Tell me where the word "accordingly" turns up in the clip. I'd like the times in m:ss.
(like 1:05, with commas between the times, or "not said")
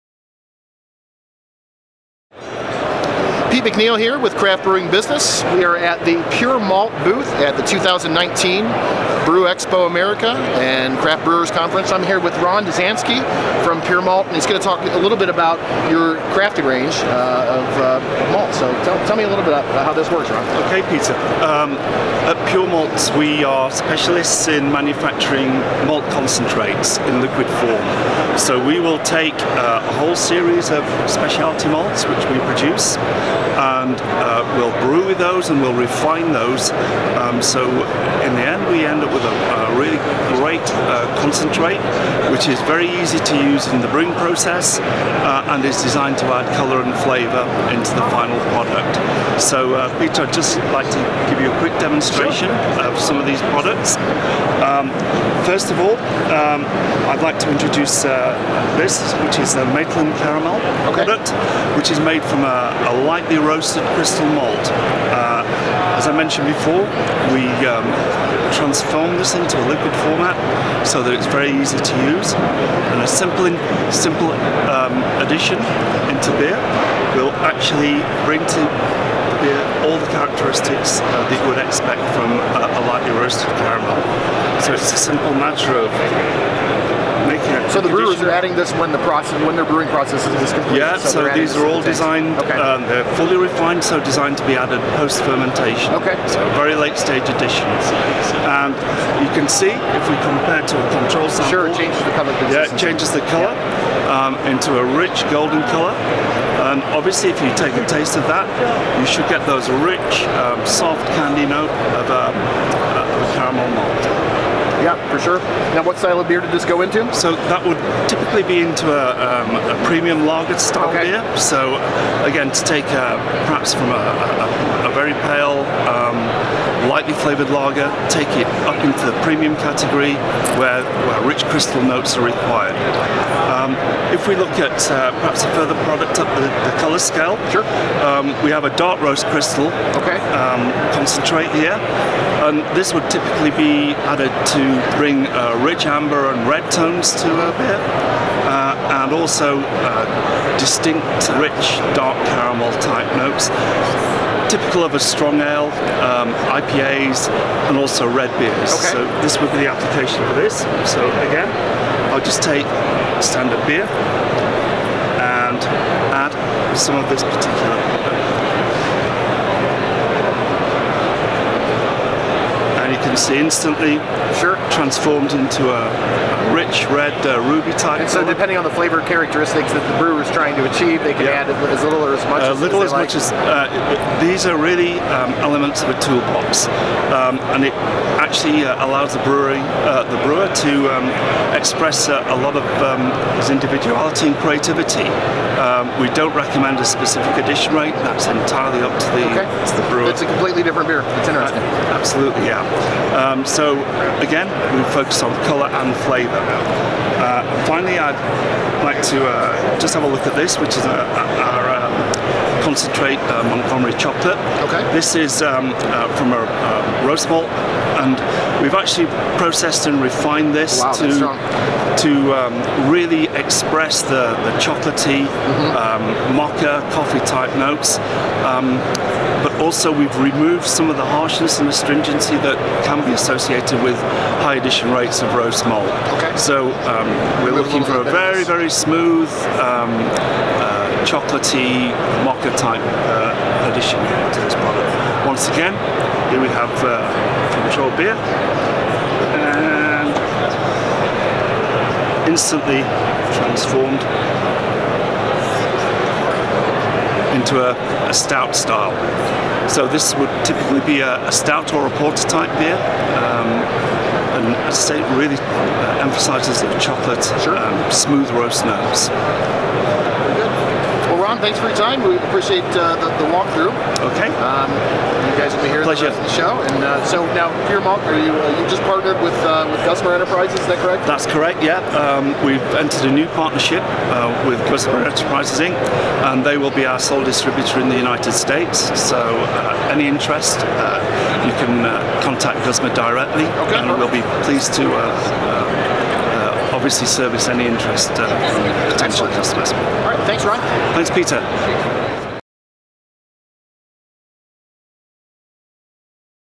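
not said.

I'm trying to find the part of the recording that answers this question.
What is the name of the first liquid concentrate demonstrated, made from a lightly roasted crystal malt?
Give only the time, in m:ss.
0:59.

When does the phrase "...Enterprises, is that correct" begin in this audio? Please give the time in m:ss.
4:40.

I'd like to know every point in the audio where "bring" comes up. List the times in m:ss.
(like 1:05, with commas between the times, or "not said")
1:18, 2:24.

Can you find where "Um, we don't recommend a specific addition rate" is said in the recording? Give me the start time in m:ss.
3:15.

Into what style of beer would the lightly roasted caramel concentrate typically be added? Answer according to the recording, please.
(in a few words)
premium lager.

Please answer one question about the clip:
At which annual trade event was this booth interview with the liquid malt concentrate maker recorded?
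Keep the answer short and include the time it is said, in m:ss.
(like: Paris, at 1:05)
Brew Expo America, at 0:09.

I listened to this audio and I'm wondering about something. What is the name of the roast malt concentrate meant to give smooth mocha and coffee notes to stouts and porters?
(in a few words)
Montgomery chocolate.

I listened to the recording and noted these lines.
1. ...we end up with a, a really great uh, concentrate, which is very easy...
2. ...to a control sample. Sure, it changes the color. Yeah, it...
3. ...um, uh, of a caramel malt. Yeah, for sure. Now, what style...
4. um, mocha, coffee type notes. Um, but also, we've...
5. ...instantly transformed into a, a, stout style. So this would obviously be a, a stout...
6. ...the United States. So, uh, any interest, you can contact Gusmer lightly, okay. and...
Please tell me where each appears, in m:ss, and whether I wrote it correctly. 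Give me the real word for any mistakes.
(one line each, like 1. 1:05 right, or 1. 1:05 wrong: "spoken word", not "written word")
1. 0:38 right
2. 1:40 right
3. 1:52 right
4. 3:45 right
5. 4:12 wrong: "typically", not "obviously"
6. 4:47 wrong: "directly", not "lightly".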